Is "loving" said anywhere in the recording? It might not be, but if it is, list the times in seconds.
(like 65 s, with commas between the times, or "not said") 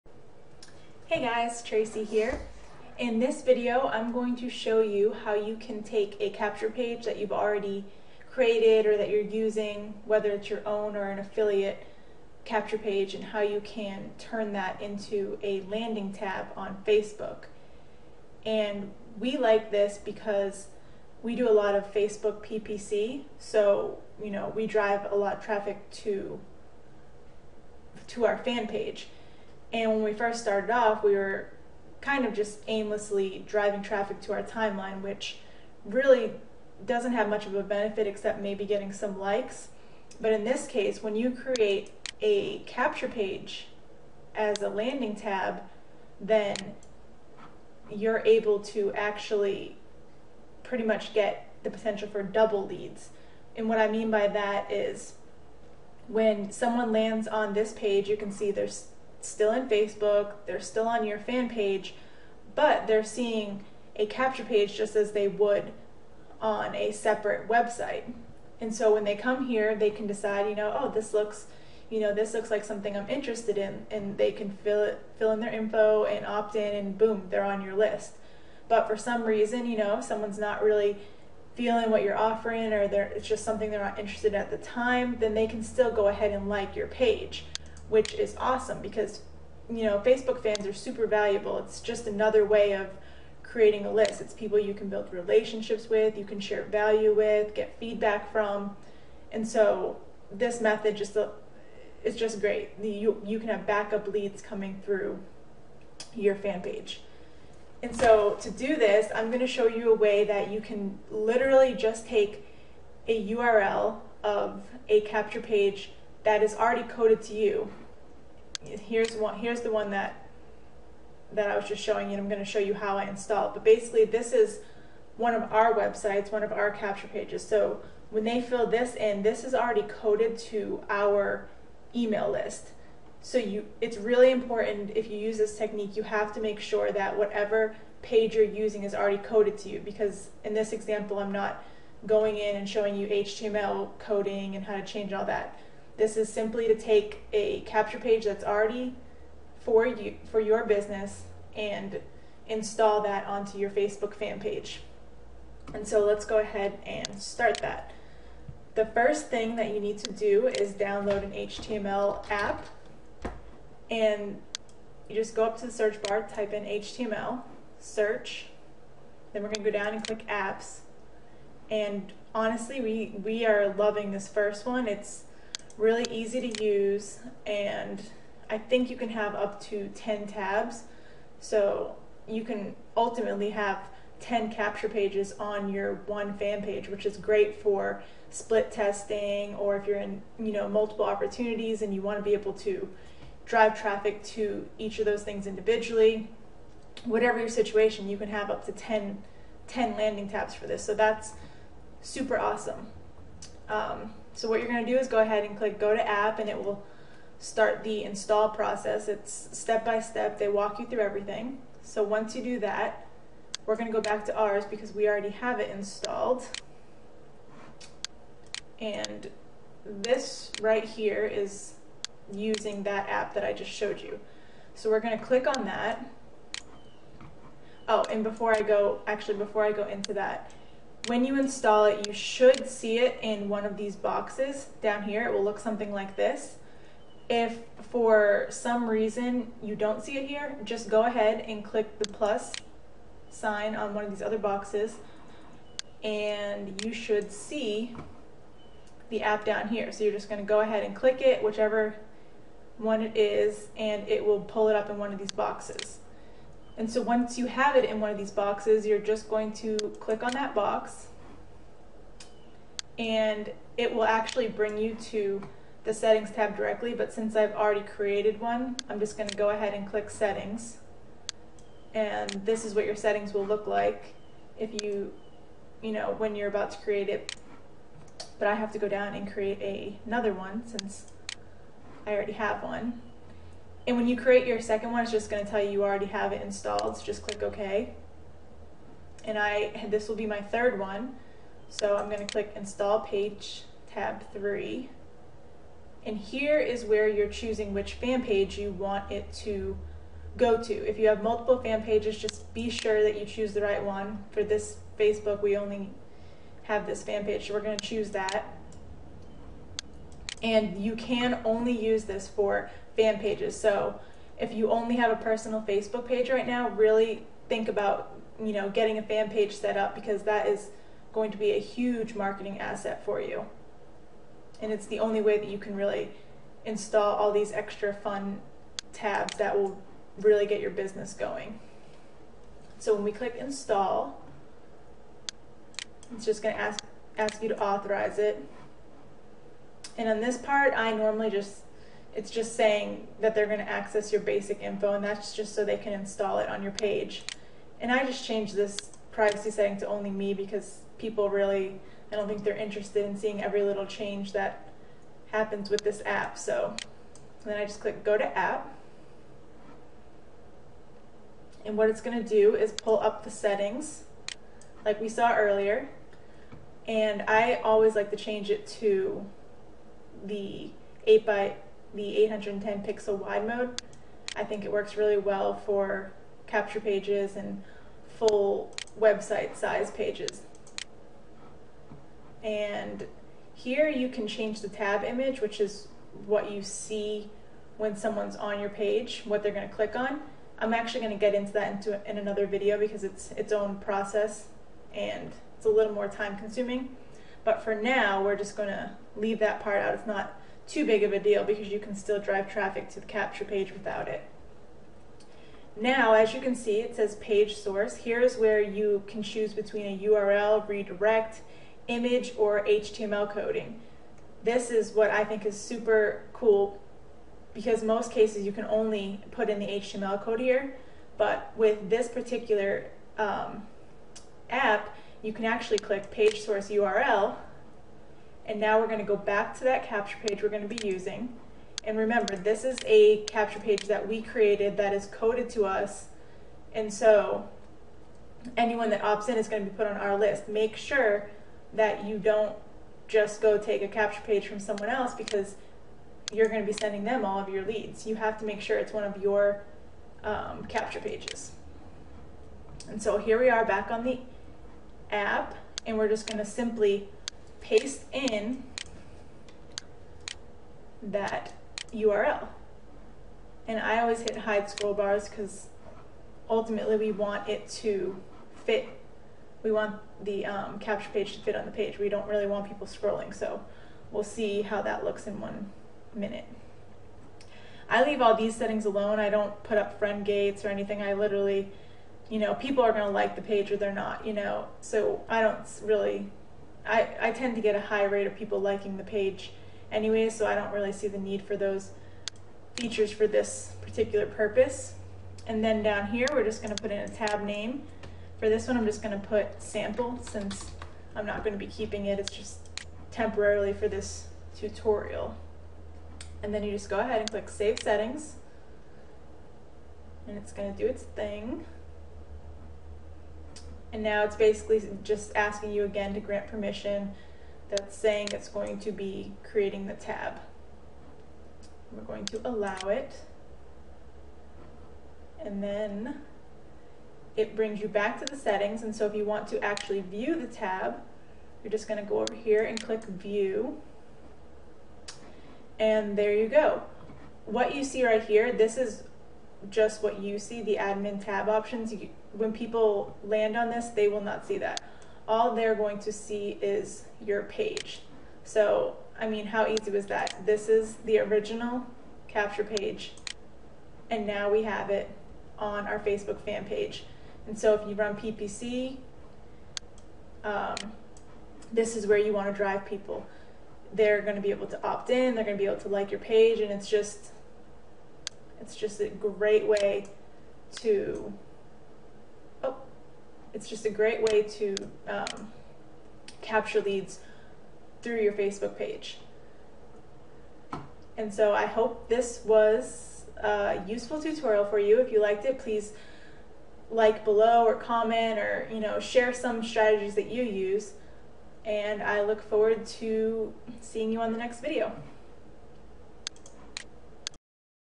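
173 s.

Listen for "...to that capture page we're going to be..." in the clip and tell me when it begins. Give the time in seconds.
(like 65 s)
429 s.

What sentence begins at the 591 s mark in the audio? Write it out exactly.
And I look forward to seeing you on the next video.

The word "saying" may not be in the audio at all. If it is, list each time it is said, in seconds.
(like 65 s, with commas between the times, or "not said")
342 s, 517 s.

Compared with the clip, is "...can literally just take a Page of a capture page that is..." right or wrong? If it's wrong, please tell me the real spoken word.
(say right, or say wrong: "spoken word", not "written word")
wrong: "URL", not "Page".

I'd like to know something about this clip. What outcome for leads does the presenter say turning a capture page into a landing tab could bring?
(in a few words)
double leads.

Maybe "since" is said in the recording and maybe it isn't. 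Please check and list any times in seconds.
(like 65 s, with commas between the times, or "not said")
267 s, 280 s, 500 s.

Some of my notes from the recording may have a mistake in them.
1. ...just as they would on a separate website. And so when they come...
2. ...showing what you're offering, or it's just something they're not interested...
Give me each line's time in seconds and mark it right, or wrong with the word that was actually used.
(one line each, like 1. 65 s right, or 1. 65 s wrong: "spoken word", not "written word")
1. 64 s right
2. 81 s wrong: "feeling", not "showing".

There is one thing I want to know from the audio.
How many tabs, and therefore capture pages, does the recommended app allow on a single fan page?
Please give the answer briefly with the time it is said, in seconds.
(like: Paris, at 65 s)
10, at 179 s.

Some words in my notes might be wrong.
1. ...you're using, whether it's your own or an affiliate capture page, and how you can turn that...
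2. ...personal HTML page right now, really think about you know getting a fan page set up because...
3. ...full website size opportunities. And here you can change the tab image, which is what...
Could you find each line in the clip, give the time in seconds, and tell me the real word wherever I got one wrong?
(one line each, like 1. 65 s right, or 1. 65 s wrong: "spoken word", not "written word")
1. 9 s right
2. 315 s wrong: "Facebook", not "HTML"
3. 378 s wrong: "pages", not "opportunities".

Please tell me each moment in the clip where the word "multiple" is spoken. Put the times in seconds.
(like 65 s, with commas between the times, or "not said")
190 s, 301 s.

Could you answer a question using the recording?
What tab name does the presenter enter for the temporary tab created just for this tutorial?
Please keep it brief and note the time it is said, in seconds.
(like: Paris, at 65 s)
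sample, at 499 s.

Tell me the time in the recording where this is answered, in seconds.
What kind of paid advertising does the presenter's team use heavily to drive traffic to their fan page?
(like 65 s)
21 s.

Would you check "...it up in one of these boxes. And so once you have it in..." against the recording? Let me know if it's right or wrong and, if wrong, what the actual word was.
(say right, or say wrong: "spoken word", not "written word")
right.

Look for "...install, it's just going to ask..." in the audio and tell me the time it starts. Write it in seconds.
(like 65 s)
333 s.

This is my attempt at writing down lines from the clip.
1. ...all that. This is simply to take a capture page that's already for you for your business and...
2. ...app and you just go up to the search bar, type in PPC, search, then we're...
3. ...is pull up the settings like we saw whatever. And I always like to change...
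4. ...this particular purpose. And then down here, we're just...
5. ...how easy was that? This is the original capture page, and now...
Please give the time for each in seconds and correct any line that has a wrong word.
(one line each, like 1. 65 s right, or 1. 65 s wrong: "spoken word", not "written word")
1. 145 s right
2. 162 s wrong: "HTML", not "PPC"
3. 362 s wrong: "earlier", not "whatever"
4. 493 s right
5. 549 s right.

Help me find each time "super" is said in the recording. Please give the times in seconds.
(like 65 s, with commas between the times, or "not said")
90 s, 202 s, 415 s.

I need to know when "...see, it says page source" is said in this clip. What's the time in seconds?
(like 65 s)
406 s.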